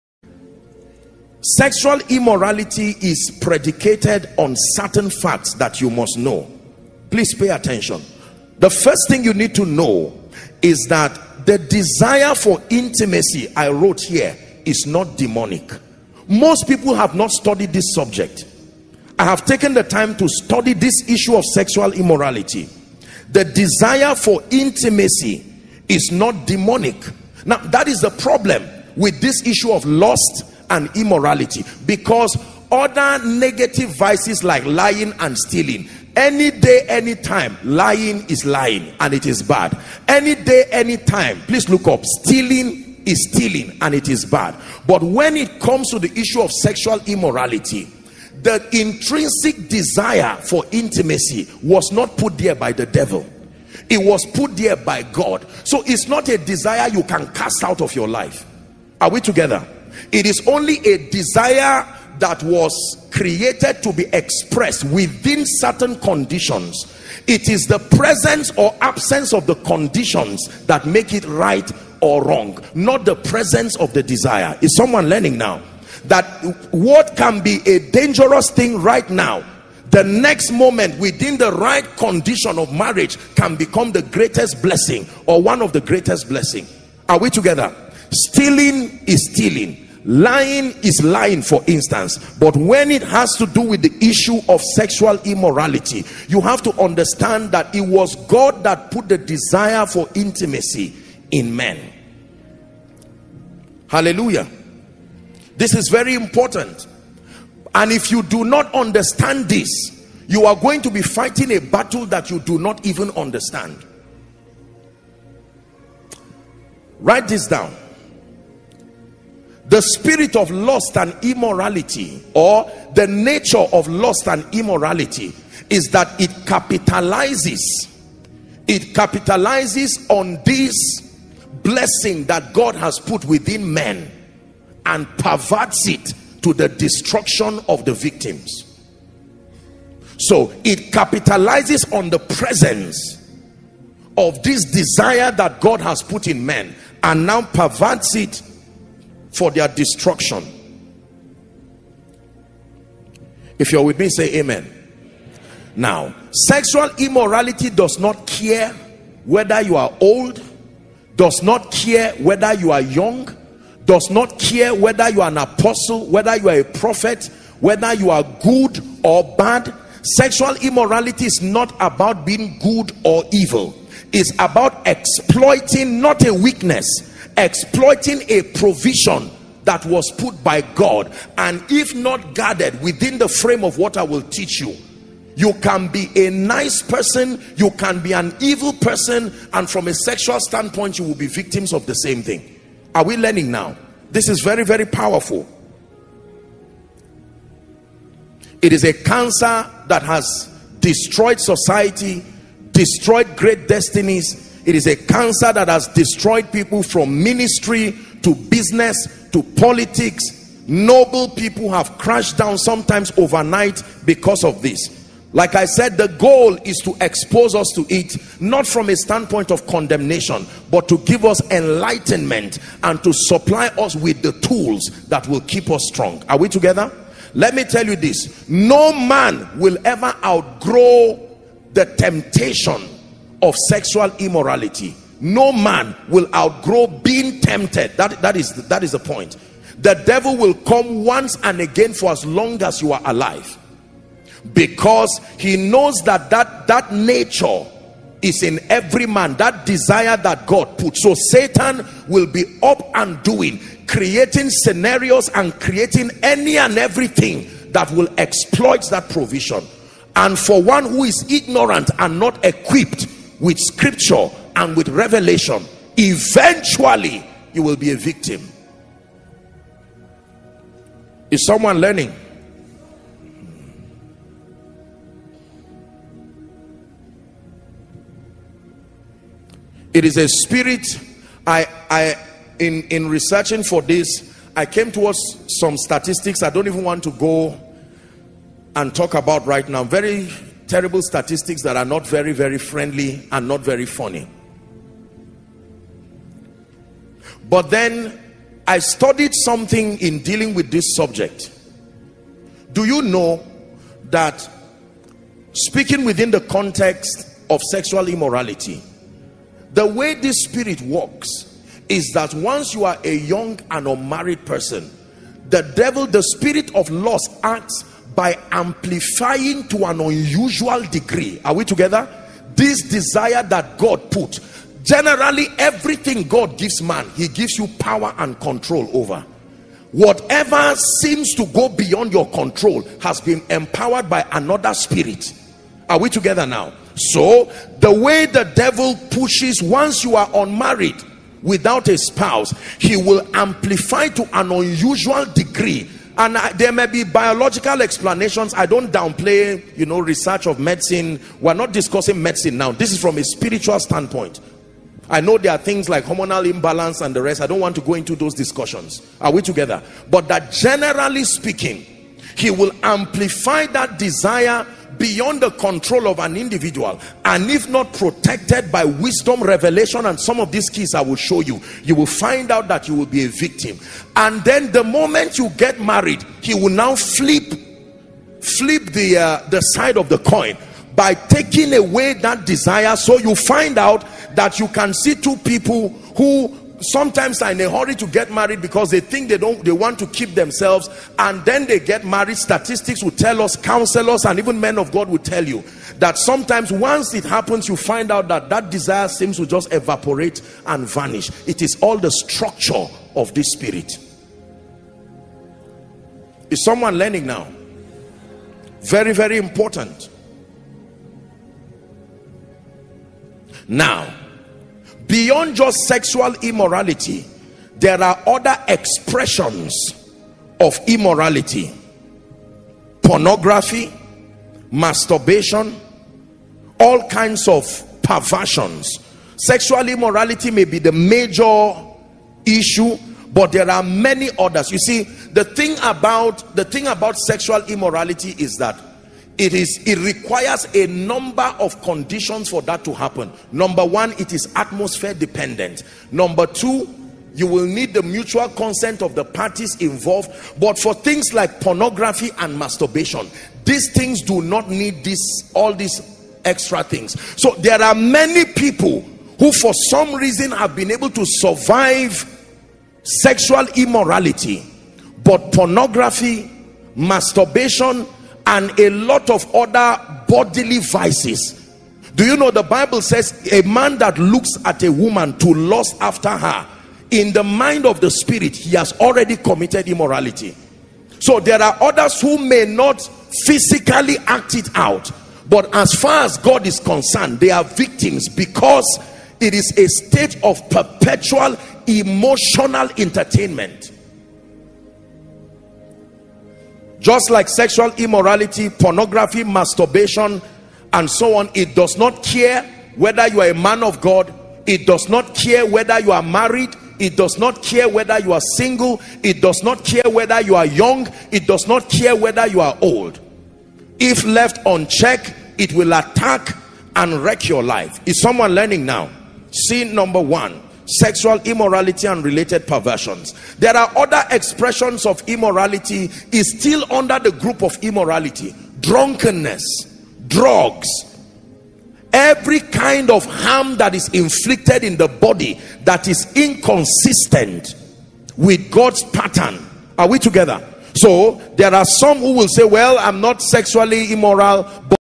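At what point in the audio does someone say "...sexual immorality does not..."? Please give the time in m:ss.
2:36.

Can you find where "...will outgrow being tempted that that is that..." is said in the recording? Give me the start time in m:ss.
3:56.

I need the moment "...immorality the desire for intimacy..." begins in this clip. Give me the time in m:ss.
0:21.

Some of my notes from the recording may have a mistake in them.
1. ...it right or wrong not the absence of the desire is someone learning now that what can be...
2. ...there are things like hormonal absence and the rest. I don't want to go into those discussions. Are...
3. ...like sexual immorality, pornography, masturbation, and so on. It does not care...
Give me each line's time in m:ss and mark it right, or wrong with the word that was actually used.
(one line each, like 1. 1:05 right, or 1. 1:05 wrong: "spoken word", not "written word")
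1. 1:11 wrong: "presence", not "absence"
2. 5:55 wrong: "imbalance", not "absence"
3. 8:17 right.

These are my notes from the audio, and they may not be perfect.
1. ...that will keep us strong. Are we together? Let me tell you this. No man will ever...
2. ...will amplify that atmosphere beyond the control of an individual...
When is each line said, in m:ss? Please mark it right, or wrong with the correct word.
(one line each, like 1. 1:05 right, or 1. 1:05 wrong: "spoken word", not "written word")
1. 3:45 right
2. 6:02 wrong: "desire", not "atmosphere".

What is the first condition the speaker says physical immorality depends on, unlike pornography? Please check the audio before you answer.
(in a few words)
atmosphere.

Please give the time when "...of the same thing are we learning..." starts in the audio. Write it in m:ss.
3:11.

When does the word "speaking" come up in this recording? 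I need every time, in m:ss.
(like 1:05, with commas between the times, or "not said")
5:05, 6:01.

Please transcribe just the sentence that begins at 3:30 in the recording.
Noble people have crashed down sometimes overnight because of this.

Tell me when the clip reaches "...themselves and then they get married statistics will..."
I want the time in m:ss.
6:30.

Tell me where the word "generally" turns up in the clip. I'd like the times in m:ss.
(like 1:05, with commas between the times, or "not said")
5:24, 6:00.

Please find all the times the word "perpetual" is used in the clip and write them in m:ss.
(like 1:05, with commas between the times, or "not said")
8:10.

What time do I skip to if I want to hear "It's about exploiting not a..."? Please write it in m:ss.
2:54.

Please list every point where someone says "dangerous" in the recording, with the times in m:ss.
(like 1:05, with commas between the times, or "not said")
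1:17.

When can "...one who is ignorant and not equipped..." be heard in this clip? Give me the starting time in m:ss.
4:20.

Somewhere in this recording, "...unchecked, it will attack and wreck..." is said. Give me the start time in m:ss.
8:34.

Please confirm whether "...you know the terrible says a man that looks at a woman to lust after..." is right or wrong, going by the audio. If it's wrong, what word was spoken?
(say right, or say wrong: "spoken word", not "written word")
wrong: "bible", not "terrible".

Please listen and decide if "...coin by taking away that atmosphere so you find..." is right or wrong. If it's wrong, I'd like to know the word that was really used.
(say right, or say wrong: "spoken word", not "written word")
wrong: "desire", not "atmosphere".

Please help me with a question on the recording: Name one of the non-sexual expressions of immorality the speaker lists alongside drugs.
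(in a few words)
drunkenness.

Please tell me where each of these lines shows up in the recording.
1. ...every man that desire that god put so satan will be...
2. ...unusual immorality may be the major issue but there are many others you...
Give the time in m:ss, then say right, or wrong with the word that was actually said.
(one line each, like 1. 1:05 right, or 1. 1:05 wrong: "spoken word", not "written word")
1. 4:08 right
2. 7:09 wrong: "sexual", not "unusual".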